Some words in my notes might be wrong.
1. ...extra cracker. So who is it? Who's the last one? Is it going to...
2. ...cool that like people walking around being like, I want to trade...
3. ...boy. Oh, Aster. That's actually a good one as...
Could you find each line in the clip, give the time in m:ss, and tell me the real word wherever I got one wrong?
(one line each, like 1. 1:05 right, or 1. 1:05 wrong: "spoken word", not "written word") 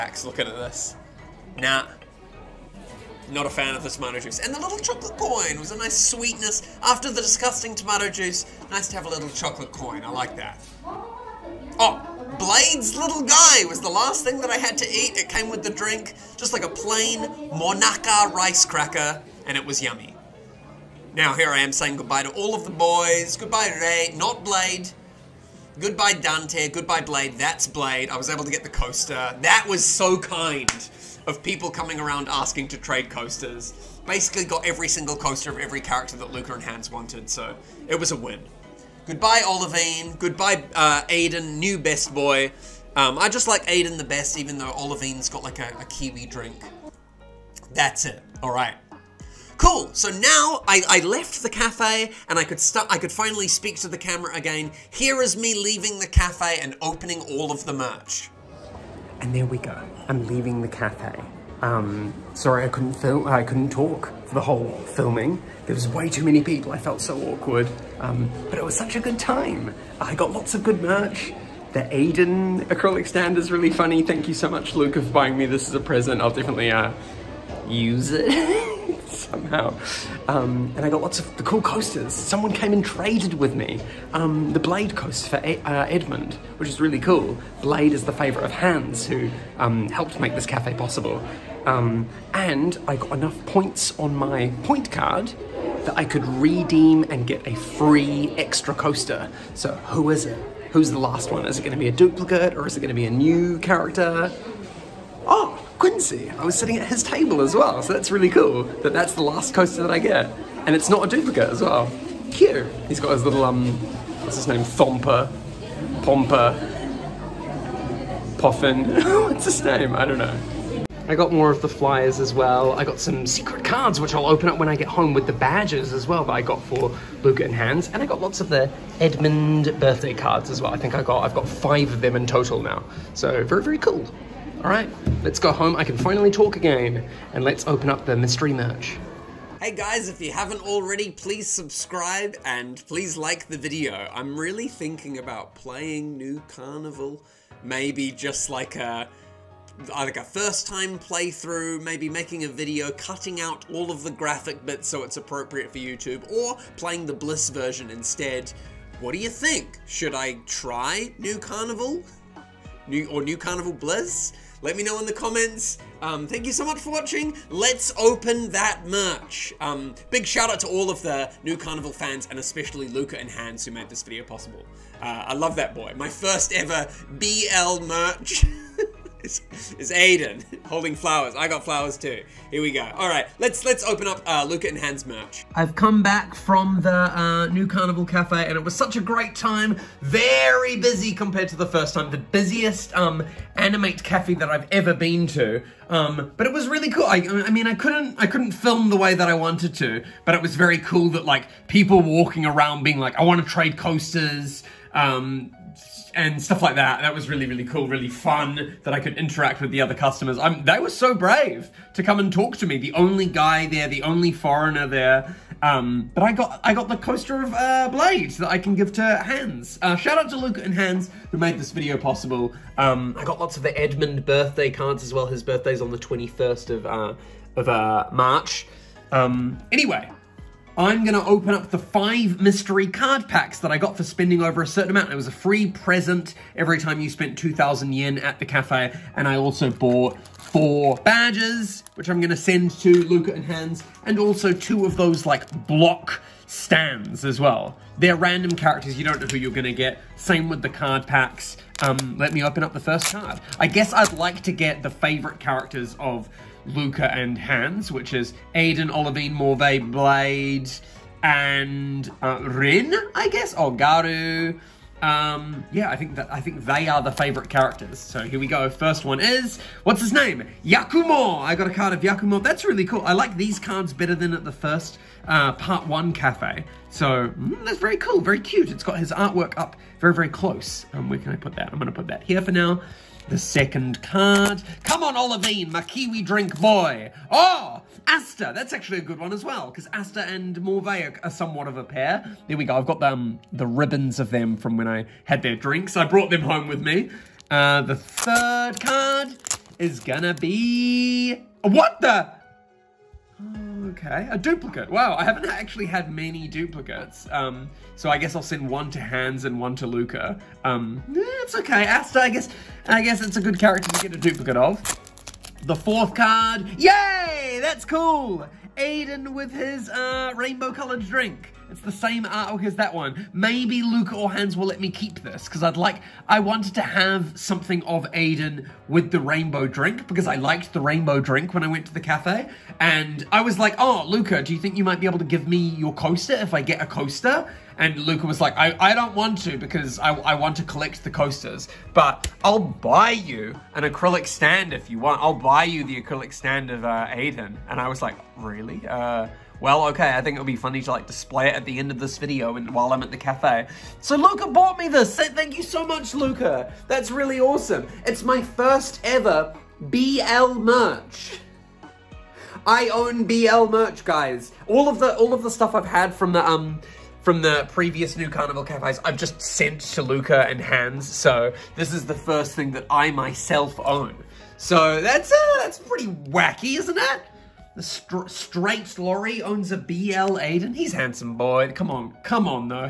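1. 1:38 wrong: "coaster", not "cracker"
2. 3:20 right
3. 4:46 right.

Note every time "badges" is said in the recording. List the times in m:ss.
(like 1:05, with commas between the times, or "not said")
2:05, 4:01.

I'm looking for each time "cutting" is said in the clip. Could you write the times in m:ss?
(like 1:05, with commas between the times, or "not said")
2:32.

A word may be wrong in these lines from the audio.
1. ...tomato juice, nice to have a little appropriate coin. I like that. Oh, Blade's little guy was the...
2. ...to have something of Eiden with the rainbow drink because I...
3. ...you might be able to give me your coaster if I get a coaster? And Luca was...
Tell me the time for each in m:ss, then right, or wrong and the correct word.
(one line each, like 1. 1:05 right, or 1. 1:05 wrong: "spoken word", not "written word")
1. 0:07 wrong: "chocolate", not "appropriate"
2. 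5:26 right
3. 5:34 right.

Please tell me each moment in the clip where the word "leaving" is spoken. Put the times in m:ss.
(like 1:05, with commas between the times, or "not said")
0:55, 1:00.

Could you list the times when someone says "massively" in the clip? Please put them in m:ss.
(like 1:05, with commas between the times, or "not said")
not said.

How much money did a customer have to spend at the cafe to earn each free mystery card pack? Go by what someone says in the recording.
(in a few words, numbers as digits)
2,000 yen.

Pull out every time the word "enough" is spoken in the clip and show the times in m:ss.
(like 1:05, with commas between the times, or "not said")
1:33.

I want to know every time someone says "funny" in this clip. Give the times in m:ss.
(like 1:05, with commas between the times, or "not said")
1:13, 5:50.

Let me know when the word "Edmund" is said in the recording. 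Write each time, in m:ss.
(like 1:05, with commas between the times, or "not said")
1:25, 2:09, 3:43.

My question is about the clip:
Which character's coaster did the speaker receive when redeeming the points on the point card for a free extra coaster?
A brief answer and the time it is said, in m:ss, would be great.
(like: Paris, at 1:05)
Quincy, at 1:45.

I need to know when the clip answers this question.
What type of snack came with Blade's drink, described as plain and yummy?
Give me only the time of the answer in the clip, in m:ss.
0:17.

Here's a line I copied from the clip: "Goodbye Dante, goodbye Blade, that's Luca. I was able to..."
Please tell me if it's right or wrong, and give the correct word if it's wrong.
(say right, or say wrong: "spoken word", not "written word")
wrong: "Blade", not "Luca".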